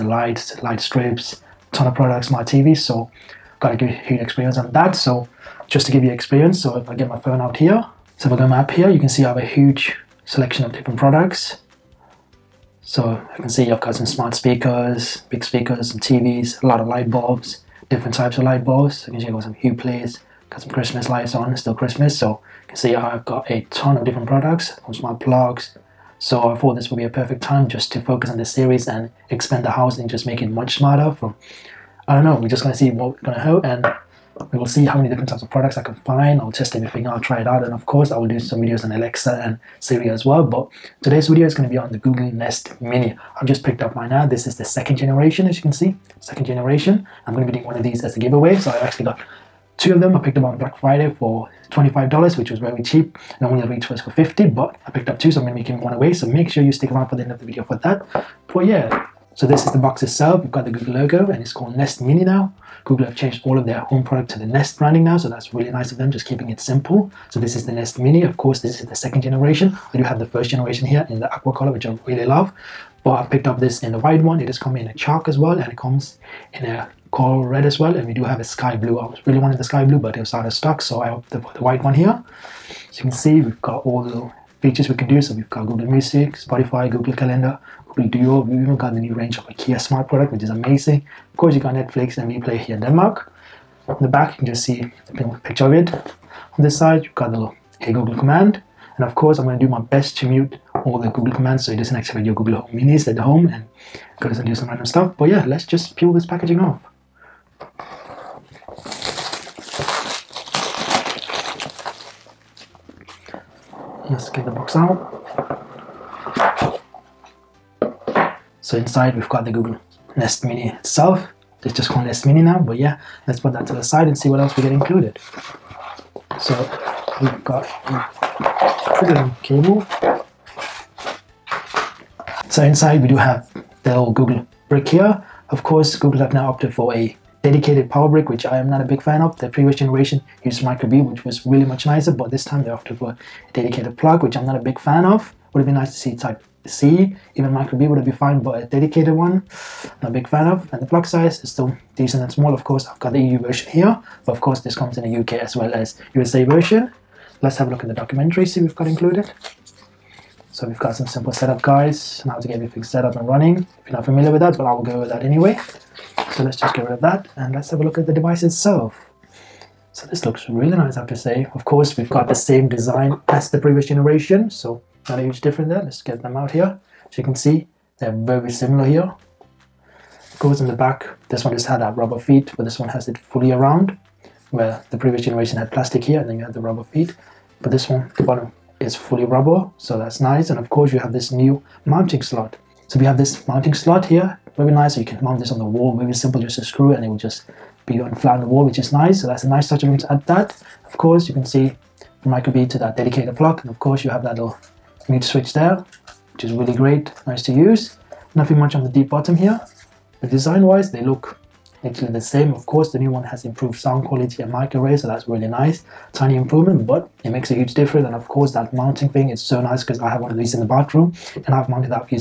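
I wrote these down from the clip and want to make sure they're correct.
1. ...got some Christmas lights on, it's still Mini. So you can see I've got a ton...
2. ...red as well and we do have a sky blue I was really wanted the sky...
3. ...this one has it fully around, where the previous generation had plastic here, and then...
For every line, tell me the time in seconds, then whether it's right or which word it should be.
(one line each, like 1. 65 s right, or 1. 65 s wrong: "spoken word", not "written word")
1. 20 s wrong: "Christmas", not "Mini"
2. 77 s right
3. 182 s right.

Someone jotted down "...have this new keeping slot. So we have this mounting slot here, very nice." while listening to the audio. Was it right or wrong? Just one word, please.
wrong.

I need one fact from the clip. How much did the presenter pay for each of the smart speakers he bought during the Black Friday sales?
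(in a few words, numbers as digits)
$25.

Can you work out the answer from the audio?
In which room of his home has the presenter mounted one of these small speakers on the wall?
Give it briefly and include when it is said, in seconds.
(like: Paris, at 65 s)
Bathroom, at 220 s.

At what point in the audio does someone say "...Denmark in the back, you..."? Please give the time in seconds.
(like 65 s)
92 s.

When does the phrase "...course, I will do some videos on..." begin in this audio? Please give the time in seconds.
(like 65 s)
37 s.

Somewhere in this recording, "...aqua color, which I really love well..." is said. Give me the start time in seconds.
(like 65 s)
71 s.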